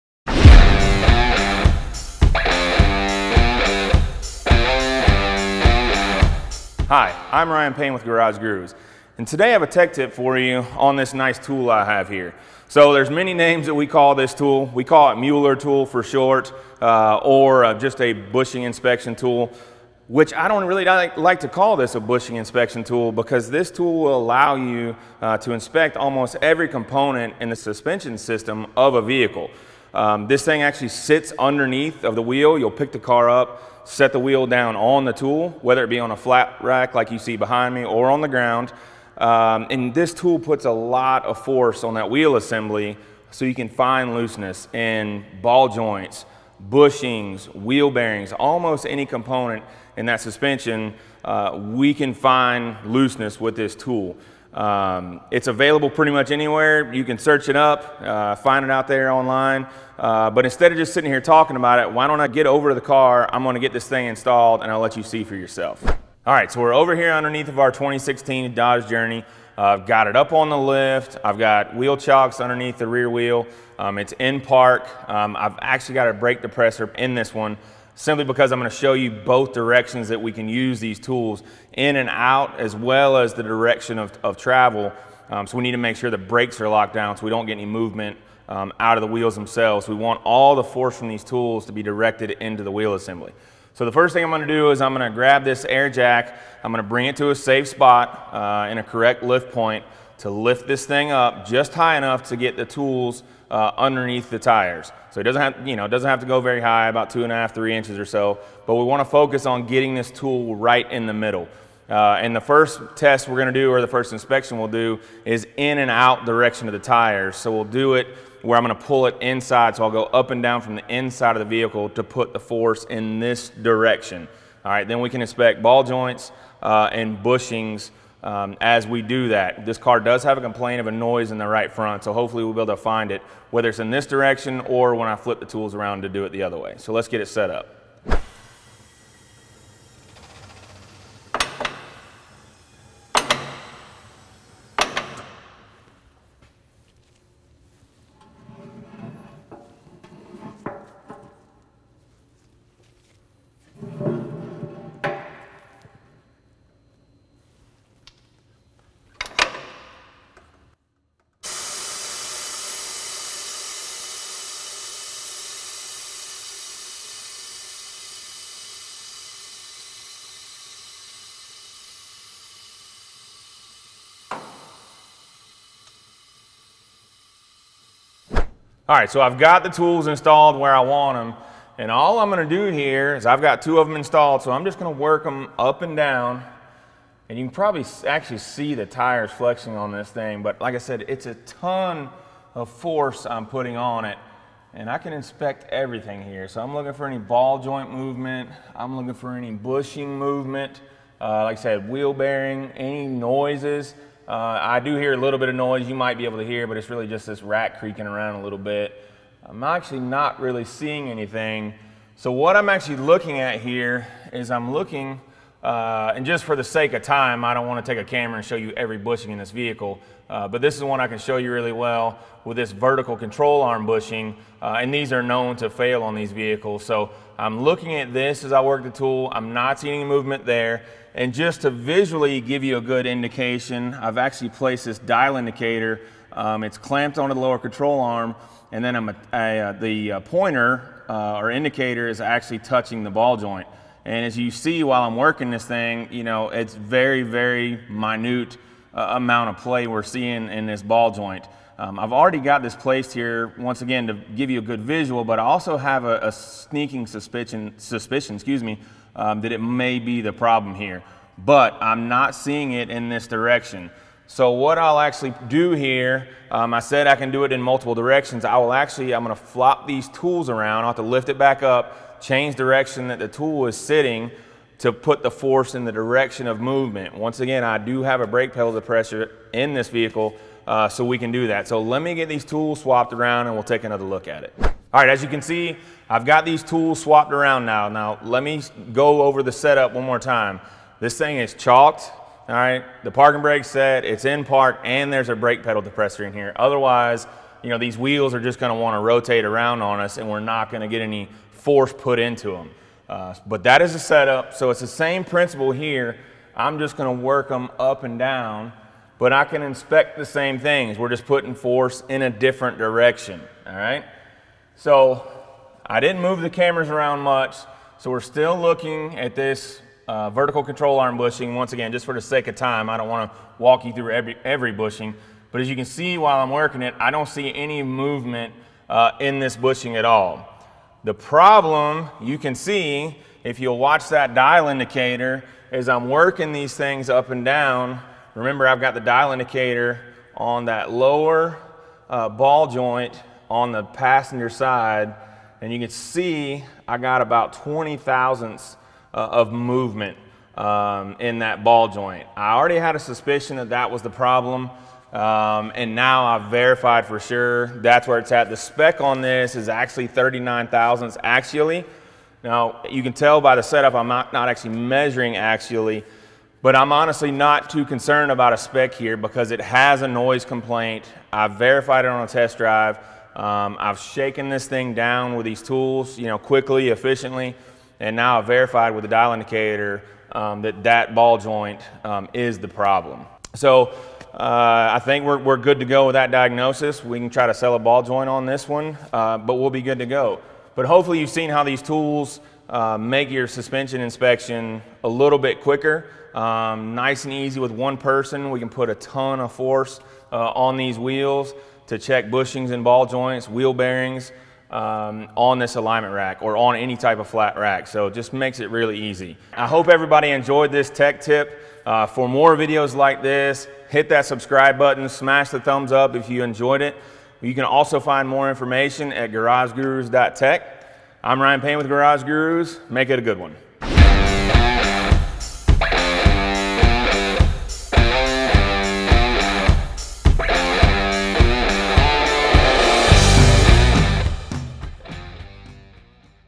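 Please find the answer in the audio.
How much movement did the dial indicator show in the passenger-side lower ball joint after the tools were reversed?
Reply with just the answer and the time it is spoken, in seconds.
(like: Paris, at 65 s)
20 thousandths, at 347 s.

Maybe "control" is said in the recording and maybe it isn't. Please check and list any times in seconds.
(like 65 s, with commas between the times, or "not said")
223 s, 237 s, 320 s.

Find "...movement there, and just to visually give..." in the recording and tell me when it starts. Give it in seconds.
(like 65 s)
230 s.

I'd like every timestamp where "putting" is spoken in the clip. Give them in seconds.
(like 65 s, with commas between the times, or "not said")
193 s, 311 s.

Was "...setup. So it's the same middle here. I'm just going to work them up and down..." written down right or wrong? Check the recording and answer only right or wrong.
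wrong.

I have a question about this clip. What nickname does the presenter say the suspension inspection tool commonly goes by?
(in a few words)
Mueller tool.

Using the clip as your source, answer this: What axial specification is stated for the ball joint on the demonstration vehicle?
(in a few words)
39 thousandths.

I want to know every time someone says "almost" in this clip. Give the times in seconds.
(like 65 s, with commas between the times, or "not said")
25 s, 48 s.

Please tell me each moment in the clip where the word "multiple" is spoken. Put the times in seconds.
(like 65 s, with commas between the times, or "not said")
267 s.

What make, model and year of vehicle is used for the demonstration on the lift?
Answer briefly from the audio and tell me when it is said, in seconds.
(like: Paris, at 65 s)
2016 Dodge Journey, at 67 s.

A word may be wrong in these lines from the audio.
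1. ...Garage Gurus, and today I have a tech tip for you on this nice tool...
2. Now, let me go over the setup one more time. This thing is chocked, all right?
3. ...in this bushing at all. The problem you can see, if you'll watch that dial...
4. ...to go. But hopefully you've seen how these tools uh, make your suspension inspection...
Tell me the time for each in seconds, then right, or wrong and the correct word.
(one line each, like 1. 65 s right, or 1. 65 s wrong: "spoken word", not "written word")
1. 8 s right
2. 287 s right
3. 329 s right
4. 389 s right.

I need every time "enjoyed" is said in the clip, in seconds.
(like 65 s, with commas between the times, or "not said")
410 s, 416 s.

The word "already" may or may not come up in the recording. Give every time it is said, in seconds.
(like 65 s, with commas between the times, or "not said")
252 s, 352 s.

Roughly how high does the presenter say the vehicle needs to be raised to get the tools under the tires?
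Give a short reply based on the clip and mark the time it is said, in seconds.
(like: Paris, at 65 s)
2.5 to 3 inches, at 107 s.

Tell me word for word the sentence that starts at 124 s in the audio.
All right, then we can inspect ball joints uh, and bushings um, as we do that.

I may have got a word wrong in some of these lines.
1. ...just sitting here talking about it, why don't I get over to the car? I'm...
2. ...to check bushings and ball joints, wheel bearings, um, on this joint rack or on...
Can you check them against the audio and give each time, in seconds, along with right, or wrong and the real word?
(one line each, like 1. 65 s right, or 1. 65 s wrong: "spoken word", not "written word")
1. 60 s right
2. 401 s wrong: "alignment", not "joint".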